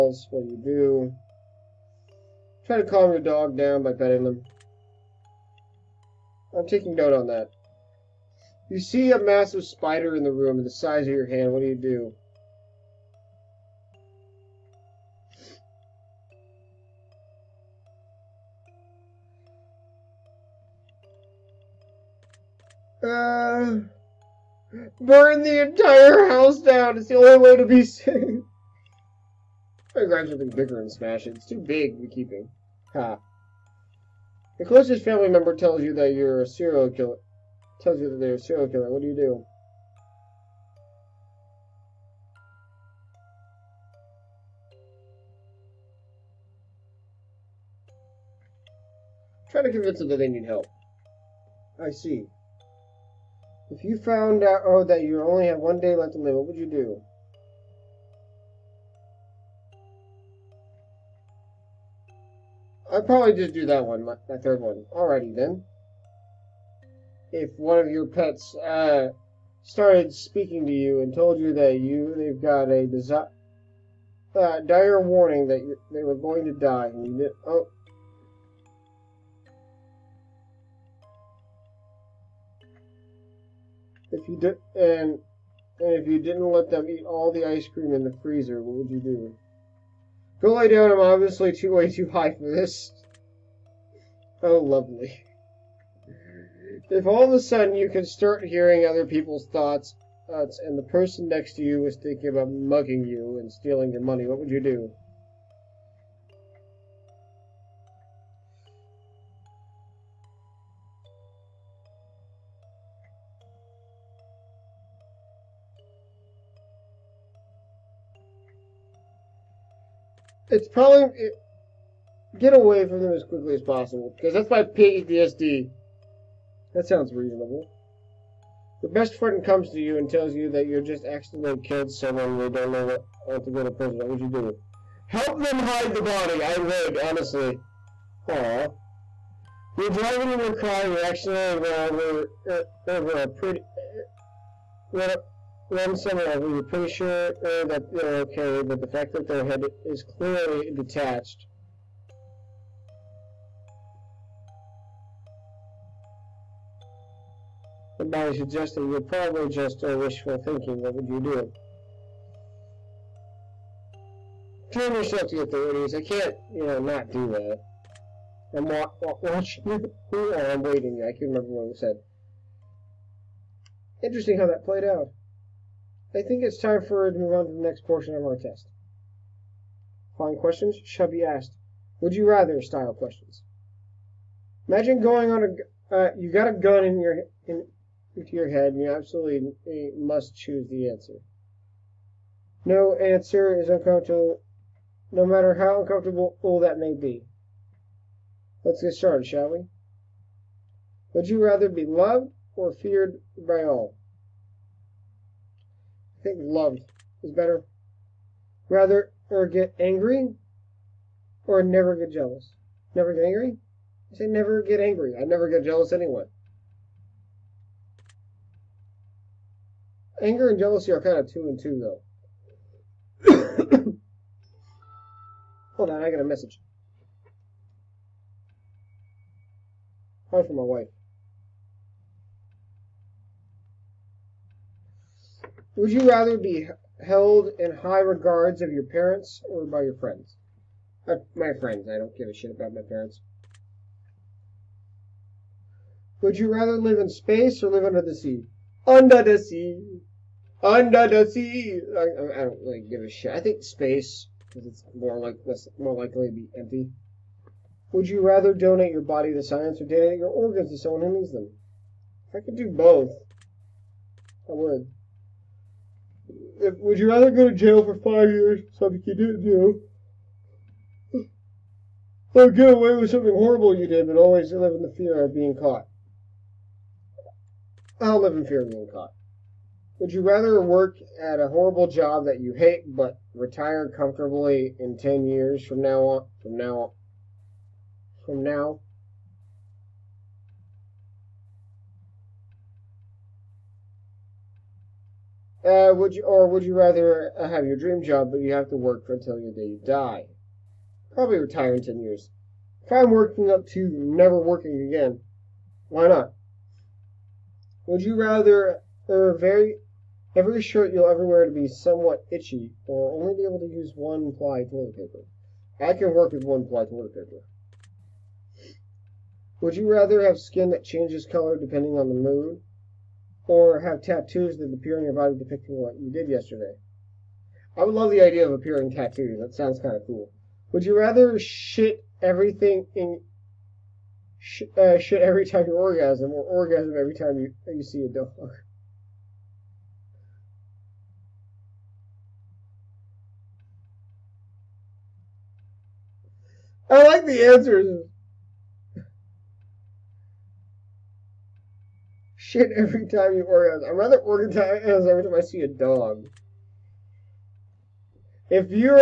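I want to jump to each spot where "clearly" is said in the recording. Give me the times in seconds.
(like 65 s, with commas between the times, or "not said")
150 s.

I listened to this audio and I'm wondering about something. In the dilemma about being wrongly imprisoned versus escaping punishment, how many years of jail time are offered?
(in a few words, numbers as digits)
5.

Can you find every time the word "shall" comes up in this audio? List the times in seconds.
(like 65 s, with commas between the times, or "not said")
180 s, 199 s.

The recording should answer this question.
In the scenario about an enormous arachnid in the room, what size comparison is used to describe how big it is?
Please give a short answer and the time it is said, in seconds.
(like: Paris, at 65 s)
the size of your hand, at 10 s.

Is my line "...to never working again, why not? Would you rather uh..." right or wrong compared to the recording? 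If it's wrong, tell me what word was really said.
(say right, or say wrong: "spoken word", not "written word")
right.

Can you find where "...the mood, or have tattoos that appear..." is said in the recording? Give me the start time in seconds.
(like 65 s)
322 s.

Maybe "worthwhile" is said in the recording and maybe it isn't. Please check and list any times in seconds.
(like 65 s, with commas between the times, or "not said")
not said.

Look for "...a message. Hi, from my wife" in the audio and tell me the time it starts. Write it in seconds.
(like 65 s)
226 s.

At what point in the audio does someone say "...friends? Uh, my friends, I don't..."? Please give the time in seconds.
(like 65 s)
239 s.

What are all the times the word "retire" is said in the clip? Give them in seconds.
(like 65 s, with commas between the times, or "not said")
283 s, 301 s.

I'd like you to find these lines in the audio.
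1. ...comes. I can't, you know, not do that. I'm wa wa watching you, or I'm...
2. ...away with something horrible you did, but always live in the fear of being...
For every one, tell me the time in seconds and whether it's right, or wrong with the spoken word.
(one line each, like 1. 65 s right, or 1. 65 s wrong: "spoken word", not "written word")
1. 165 s wrong: "authorities", not "comes"
2. 272 s right.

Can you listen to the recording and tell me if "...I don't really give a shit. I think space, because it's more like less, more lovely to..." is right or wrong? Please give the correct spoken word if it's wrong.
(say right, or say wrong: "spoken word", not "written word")
wrong: "likely", not "lovely".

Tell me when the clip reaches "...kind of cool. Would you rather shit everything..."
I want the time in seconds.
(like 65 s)
329 s.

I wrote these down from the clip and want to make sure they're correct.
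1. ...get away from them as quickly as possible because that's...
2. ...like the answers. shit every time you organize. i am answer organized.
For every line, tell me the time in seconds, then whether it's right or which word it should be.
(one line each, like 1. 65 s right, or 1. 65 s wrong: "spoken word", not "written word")
1. 122 s right
2. 347 s wrong: "rather", not "answer".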